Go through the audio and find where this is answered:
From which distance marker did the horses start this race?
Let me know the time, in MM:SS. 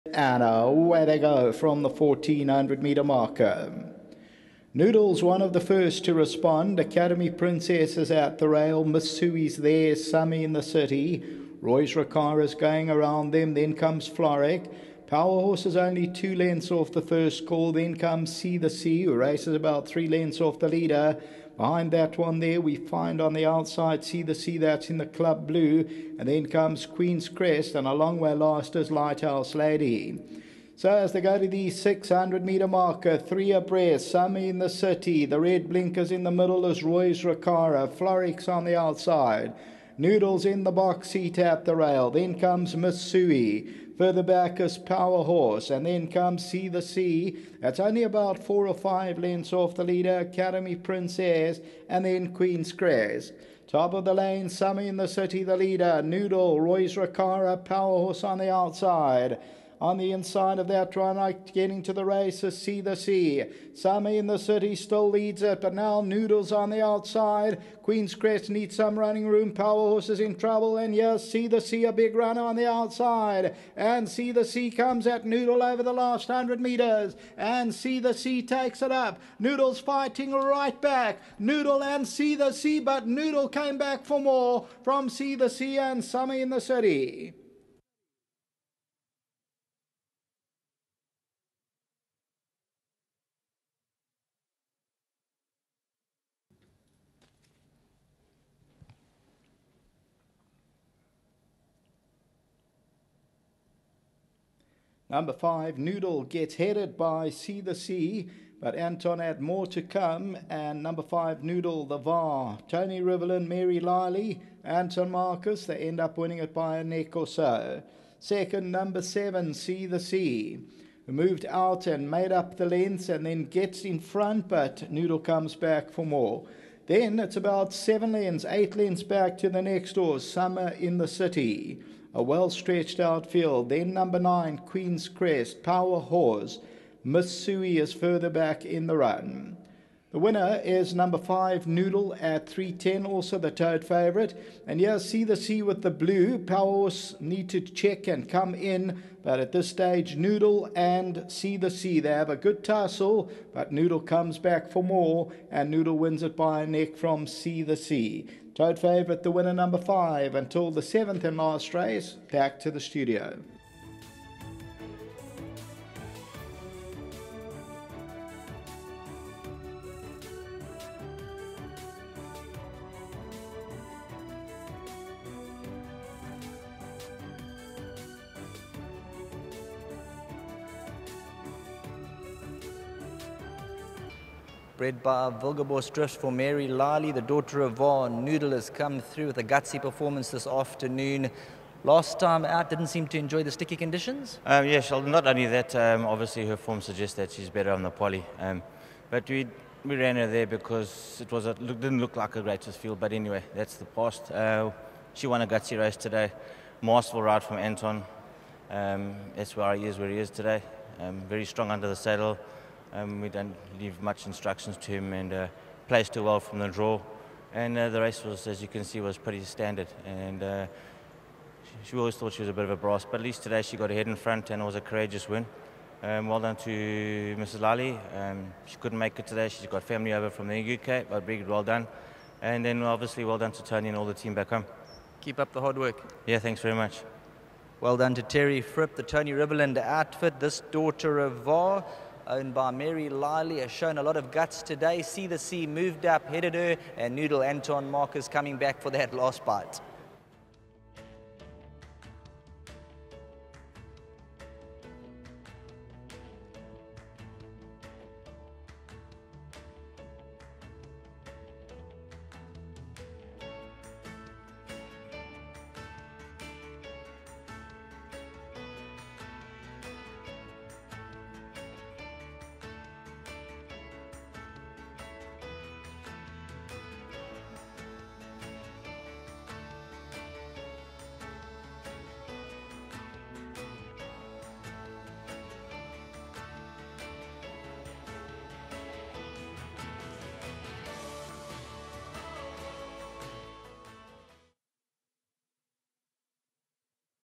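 00:01.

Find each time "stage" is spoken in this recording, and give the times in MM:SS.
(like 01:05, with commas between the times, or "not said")
02:29.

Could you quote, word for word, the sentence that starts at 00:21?
Behind that one there, we find on the outside See the Sea that's in the club blue.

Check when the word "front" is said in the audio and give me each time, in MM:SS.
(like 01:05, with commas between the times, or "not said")
02:03, 03:44.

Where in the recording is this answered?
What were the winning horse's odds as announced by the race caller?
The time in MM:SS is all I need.
02:22.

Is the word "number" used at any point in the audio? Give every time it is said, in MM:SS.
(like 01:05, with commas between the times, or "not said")
01:45, 01:50, 01:58, 02:13, 02:20, 02:39.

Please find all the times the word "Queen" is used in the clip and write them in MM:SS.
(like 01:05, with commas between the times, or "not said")
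00:26, 00:52, 01:07, 02:14.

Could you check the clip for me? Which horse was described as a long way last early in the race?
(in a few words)
Lighthouse Lady.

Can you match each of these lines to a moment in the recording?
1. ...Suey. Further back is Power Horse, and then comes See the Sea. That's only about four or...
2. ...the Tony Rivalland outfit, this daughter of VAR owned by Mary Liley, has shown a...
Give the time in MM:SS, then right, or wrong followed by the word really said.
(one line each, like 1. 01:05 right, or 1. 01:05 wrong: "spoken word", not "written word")
1. 00:43 right
2. 03:58 right.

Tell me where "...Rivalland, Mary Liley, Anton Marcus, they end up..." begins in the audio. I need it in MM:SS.
01:53.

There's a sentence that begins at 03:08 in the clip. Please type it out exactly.
Noodle has come through with a gutsy performance this afternoon.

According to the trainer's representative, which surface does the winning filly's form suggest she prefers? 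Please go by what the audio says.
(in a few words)
Poly.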